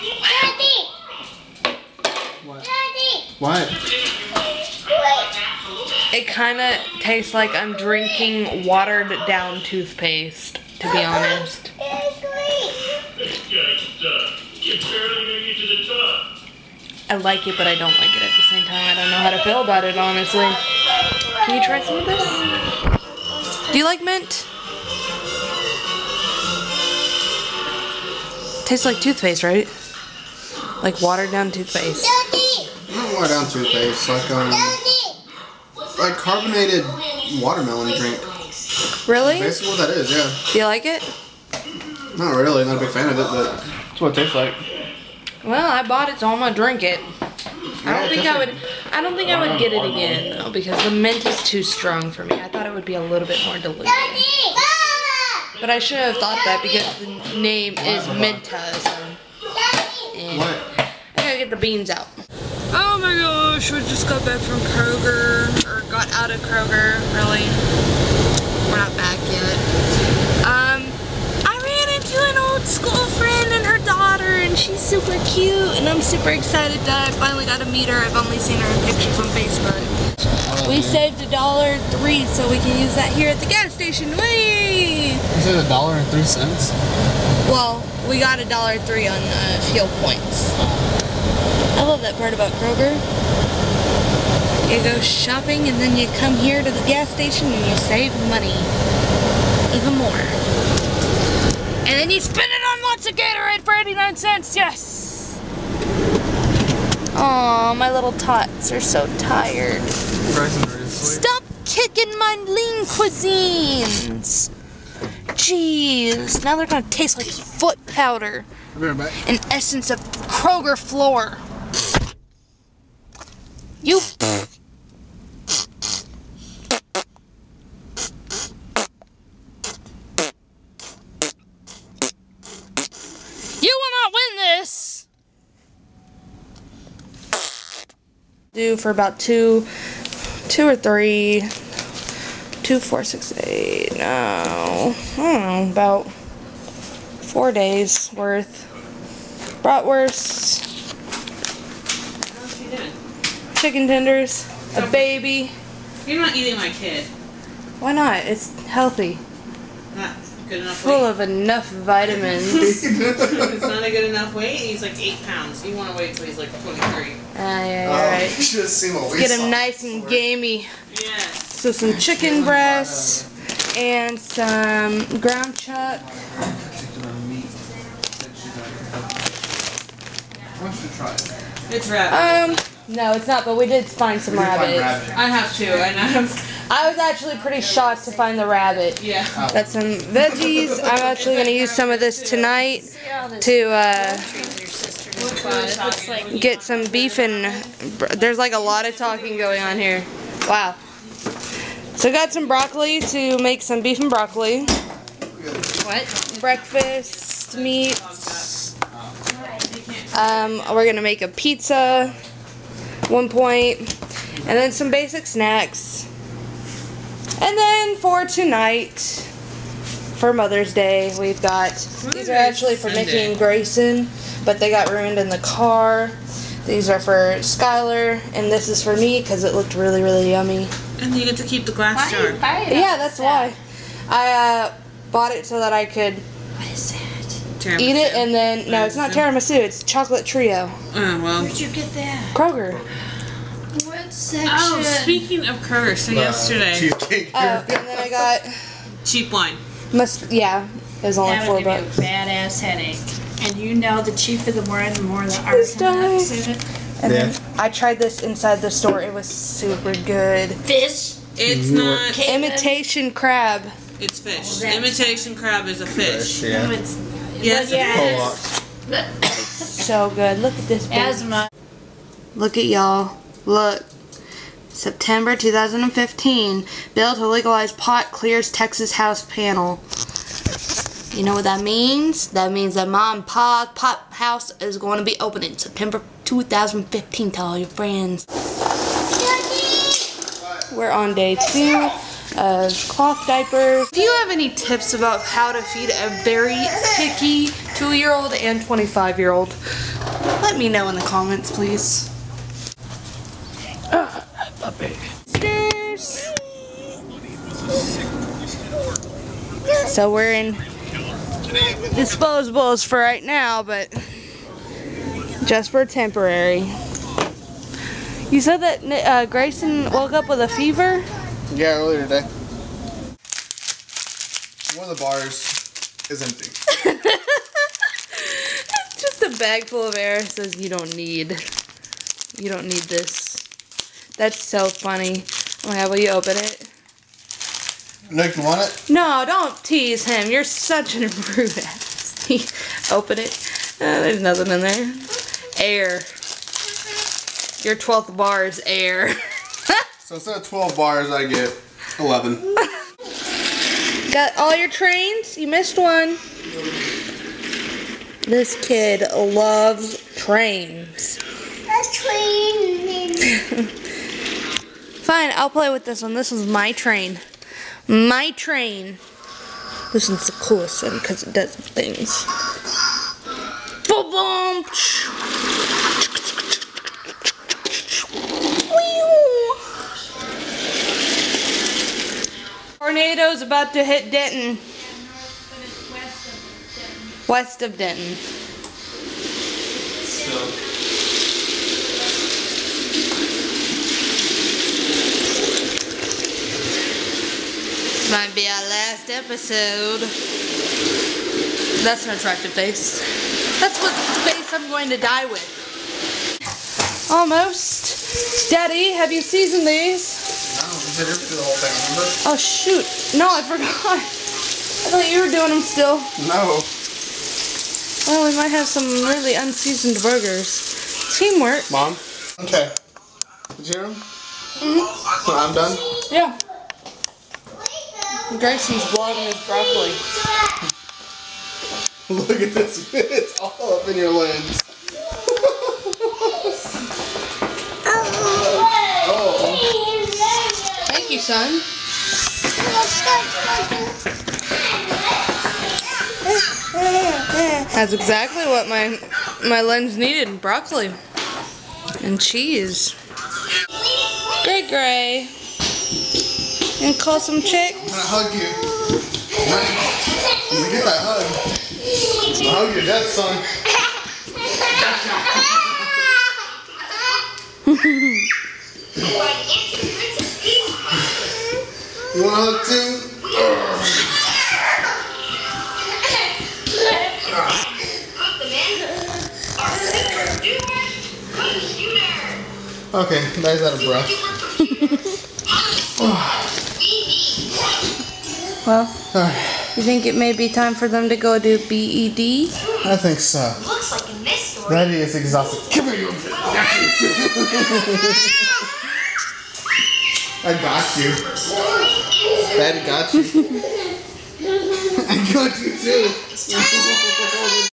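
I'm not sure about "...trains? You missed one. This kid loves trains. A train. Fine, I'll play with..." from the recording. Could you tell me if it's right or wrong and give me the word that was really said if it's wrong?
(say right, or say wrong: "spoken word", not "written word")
right.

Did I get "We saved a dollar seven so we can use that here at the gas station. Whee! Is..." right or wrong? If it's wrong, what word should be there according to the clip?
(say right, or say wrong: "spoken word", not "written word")
wrong: "three", not "seven".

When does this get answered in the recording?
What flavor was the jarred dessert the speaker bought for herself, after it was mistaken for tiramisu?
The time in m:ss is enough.
3:59.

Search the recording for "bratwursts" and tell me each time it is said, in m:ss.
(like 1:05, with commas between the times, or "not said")
2:29.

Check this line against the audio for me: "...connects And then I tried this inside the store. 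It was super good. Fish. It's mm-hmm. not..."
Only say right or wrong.
right.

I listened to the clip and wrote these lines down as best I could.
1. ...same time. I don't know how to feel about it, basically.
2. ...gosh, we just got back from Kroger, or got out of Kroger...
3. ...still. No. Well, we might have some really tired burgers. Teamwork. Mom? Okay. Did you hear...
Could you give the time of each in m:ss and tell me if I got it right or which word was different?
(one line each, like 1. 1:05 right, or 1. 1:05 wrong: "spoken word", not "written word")
1. 0:18 wrong: "honestly", not "basically"
2. 1:03 right
3. 6:55 wrong: "unseasoned", not "tired".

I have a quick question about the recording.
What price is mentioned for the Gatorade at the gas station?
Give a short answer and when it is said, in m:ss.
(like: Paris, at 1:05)
89 cents, at 1:43.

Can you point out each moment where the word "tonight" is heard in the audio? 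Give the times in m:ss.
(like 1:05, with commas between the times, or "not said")
3:12, 3:38.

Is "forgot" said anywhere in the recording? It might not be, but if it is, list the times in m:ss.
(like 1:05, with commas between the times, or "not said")
6:53.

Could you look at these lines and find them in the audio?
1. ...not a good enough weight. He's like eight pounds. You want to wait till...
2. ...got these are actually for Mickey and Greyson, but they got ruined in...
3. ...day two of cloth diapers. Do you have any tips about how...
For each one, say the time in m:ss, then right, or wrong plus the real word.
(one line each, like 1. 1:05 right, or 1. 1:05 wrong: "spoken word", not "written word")
1. 2:43 right
2. 3:41 right
3. 4:51 right.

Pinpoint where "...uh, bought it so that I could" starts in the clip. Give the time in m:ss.
3:54.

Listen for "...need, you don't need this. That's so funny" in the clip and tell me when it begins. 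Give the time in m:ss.
5:30.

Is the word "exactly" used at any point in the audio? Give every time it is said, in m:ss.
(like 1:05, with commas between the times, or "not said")
7:27.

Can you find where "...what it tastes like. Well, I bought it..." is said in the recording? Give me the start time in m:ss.
0:44.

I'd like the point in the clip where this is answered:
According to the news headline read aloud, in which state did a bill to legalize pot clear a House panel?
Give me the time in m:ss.
4:38.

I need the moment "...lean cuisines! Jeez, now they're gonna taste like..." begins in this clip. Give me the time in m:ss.
1:52.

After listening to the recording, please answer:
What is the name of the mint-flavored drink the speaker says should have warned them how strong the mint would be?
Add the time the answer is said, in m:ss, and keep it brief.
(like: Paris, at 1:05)
Minta, at 0:58.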